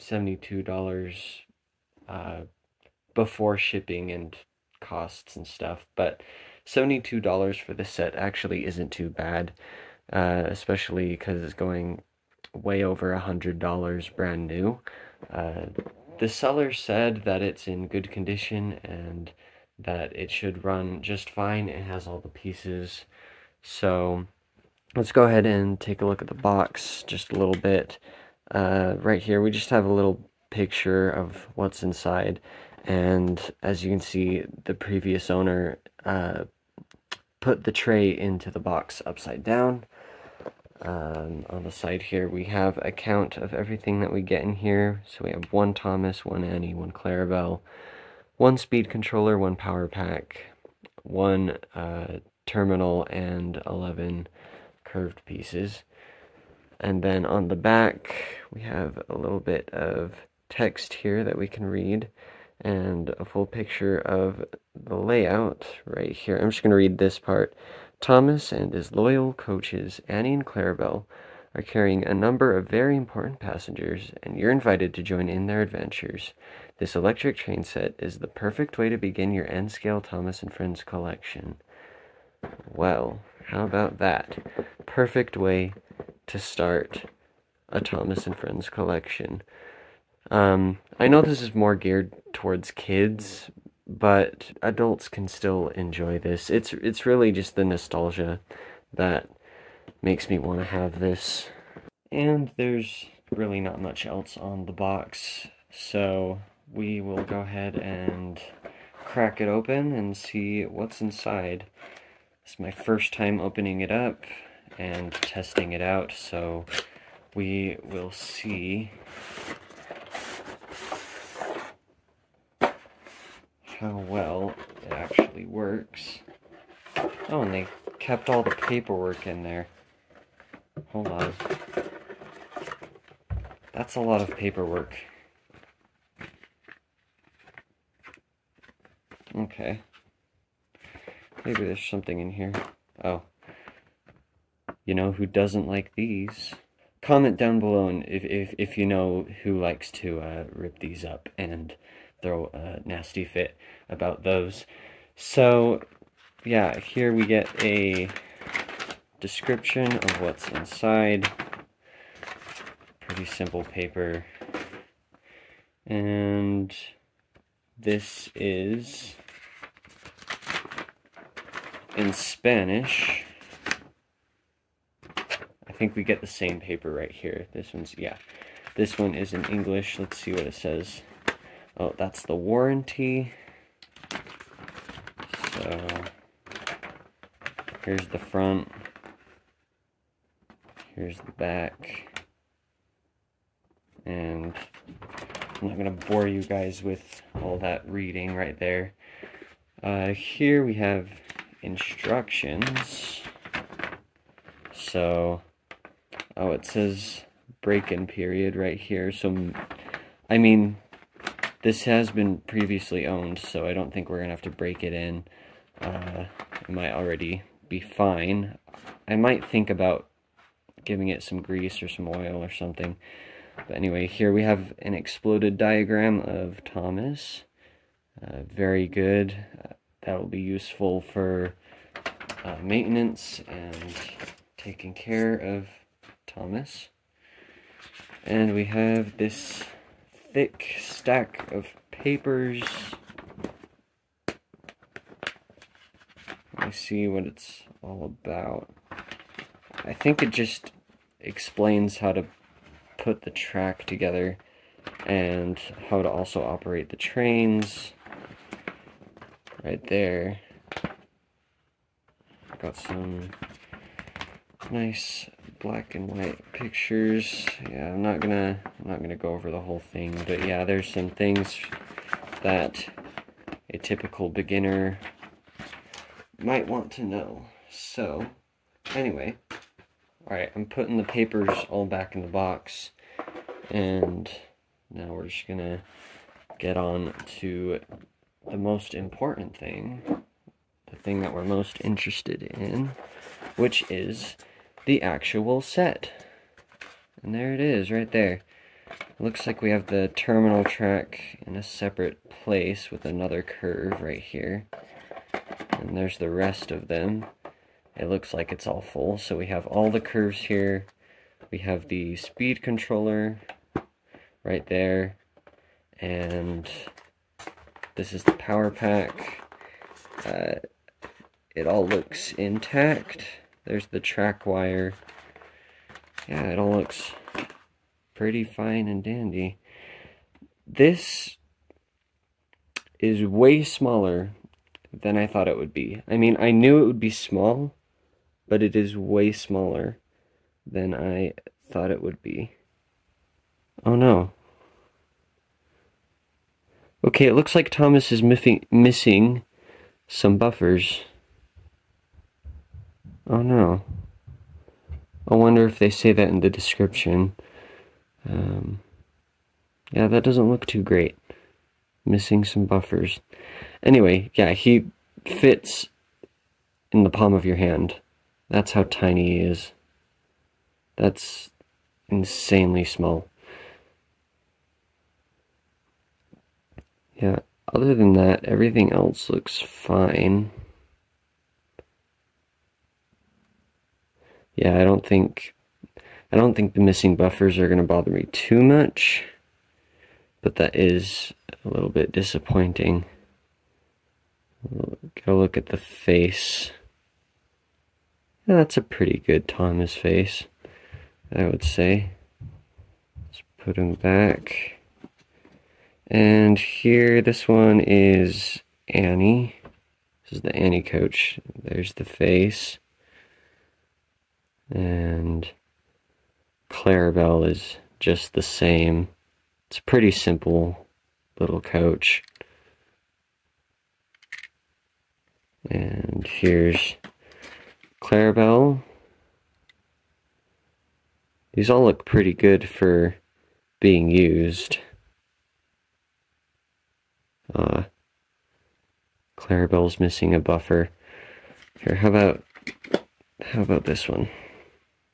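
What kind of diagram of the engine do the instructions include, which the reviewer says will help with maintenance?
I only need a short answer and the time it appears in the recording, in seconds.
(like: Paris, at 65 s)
Exploded diagram, at 224 s.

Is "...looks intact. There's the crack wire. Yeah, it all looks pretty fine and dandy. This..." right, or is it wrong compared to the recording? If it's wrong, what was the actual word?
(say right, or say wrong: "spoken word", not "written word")
wrong: "track", not "crack".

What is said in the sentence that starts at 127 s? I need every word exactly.
Oh, and they kept all the paperwork in there.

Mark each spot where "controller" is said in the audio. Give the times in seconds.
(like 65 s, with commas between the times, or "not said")
48 s, 312 s.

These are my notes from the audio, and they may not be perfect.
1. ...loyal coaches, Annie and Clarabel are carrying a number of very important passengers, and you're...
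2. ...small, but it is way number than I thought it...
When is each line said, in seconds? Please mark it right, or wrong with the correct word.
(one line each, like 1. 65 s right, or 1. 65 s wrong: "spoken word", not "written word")
1. 68 s right
2. 337 s wrong: "smaller", not "number".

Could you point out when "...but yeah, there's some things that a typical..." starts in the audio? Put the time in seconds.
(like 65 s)
270 s.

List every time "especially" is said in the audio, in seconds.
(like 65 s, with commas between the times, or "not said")
10 s.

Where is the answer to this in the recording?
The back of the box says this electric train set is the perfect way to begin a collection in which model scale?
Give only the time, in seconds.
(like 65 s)
79 s.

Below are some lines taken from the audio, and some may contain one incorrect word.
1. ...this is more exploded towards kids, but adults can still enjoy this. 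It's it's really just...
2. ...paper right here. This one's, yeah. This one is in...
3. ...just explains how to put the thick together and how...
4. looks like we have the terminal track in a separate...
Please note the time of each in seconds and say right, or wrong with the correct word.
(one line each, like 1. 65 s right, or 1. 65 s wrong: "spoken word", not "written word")
1. 91 s wrong: "geared", not "exploded"
2. 176 s right
3. 250 s wrong: "track", not "thick"
4. 299 s right.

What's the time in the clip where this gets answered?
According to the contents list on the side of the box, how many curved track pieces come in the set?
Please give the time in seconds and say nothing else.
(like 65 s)
53 s.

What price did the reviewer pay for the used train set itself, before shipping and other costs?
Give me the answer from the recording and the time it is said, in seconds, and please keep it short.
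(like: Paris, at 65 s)
$72, at 6 s.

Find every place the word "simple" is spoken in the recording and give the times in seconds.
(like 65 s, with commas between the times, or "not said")
163 s, 420 s.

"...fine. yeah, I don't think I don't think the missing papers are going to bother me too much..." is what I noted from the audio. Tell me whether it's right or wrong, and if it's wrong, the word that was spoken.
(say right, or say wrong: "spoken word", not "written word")
wrong: "buffers", not "papers".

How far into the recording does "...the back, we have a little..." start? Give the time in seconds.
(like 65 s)
57 s.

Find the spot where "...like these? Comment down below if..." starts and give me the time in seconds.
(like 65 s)
145 s.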